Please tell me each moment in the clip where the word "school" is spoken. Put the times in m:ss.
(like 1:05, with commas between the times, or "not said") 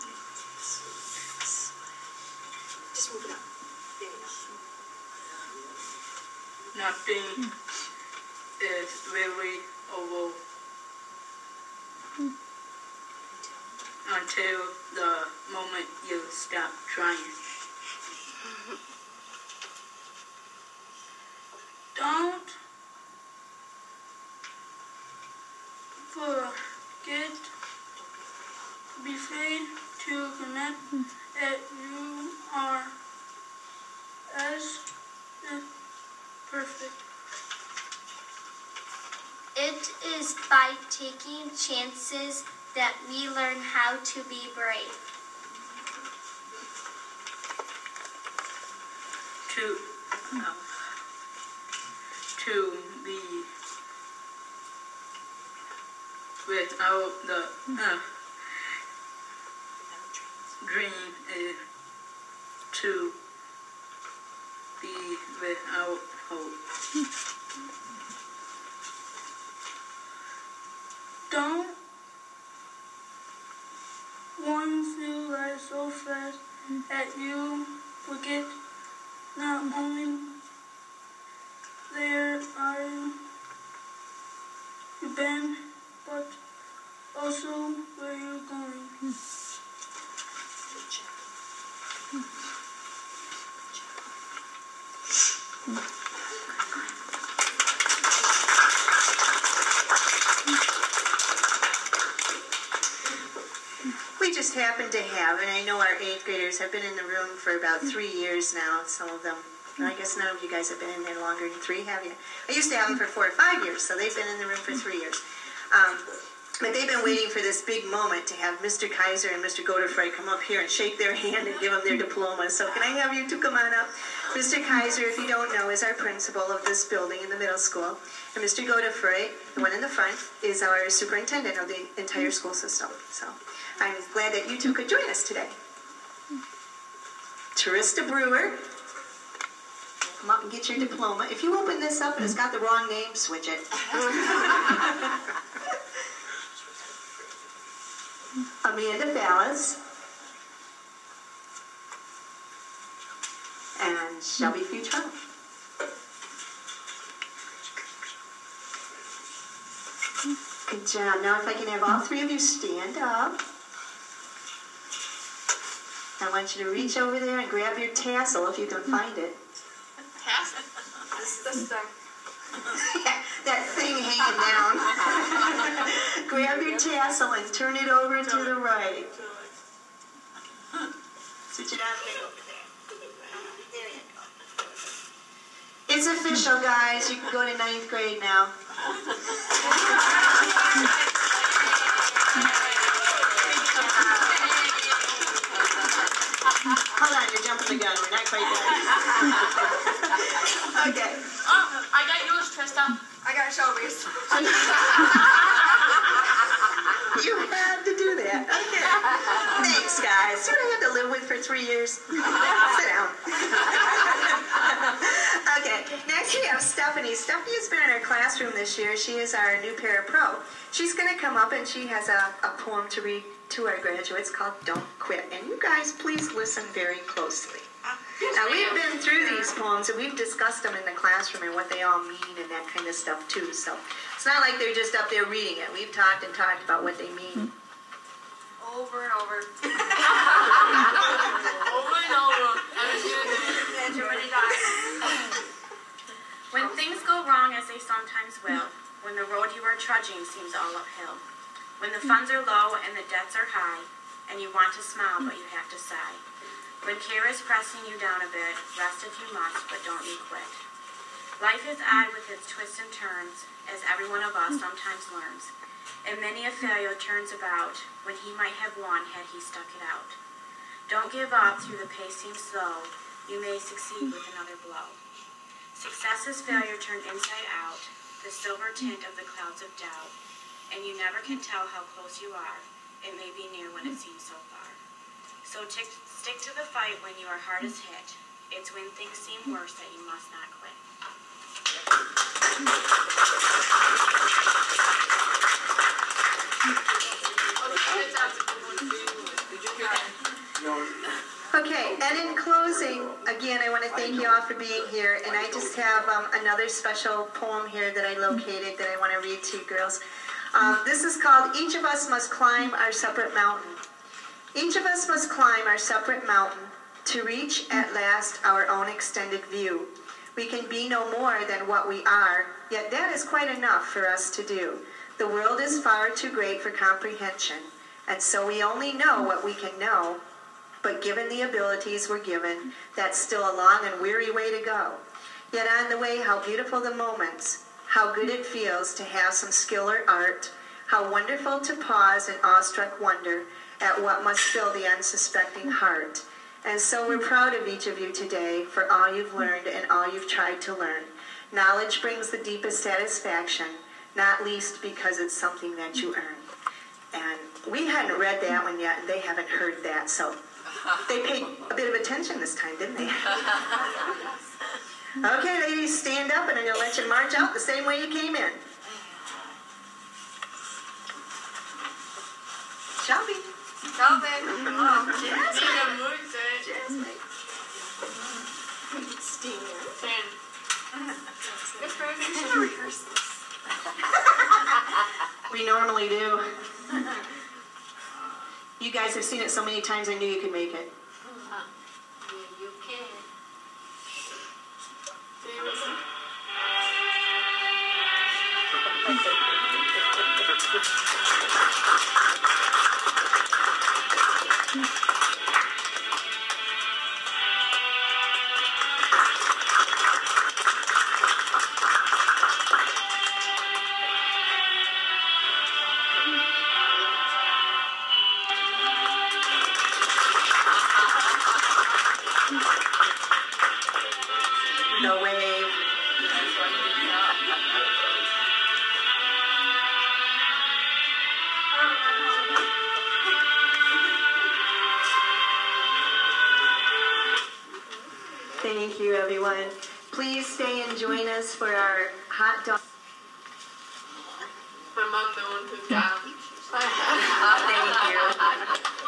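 2:07, 2:12.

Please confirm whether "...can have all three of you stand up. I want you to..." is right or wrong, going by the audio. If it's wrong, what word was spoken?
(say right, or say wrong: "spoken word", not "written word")
right.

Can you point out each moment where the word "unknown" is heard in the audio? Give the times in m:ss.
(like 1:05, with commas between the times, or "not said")
not said.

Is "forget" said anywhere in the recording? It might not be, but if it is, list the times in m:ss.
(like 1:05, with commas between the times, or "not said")
0:26, 1:18.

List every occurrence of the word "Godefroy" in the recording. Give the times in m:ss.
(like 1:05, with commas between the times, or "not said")
1:59, 2:08.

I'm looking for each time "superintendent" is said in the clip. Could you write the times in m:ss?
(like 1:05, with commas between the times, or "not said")
2:10.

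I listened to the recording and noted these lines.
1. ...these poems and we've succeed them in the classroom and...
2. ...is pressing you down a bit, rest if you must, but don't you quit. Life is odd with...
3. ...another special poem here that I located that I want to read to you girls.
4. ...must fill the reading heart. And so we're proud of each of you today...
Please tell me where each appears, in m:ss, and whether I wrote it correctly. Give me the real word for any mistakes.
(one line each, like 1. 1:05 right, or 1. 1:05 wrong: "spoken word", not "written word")
1. 3:49 wrong: "discussed", not "succeed"
2. 4:17 right
3. 5:06 right
4. 5:44 wrong: "unsuspecting", not "reading".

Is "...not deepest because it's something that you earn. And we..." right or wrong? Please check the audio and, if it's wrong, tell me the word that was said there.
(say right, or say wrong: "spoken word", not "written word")
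wrong: "least", not "deepest".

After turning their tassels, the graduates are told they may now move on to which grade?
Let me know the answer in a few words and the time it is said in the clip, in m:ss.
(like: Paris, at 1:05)
ninth grade, at 3:07.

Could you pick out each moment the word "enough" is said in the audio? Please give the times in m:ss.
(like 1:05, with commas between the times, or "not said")
5:23.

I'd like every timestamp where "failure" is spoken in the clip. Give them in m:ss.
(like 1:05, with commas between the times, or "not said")
4:26, 4:36.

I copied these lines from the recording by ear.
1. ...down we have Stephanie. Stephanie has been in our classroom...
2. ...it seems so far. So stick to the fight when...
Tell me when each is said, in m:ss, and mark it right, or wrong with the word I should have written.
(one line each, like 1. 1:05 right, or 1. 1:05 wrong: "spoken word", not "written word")
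1. 3:32 right
2. 4:43 right.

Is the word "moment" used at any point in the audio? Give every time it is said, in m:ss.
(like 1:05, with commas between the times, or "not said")
0:15, 1:57, 5:36.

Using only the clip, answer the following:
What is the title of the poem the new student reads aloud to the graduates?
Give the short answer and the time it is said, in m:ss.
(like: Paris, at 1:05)
Don't Quit, at 3:44.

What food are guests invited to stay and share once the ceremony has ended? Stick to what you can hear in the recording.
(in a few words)
hot dog.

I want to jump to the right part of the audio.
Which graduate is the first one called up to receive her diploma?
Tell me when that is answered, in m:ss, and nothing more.
2:17.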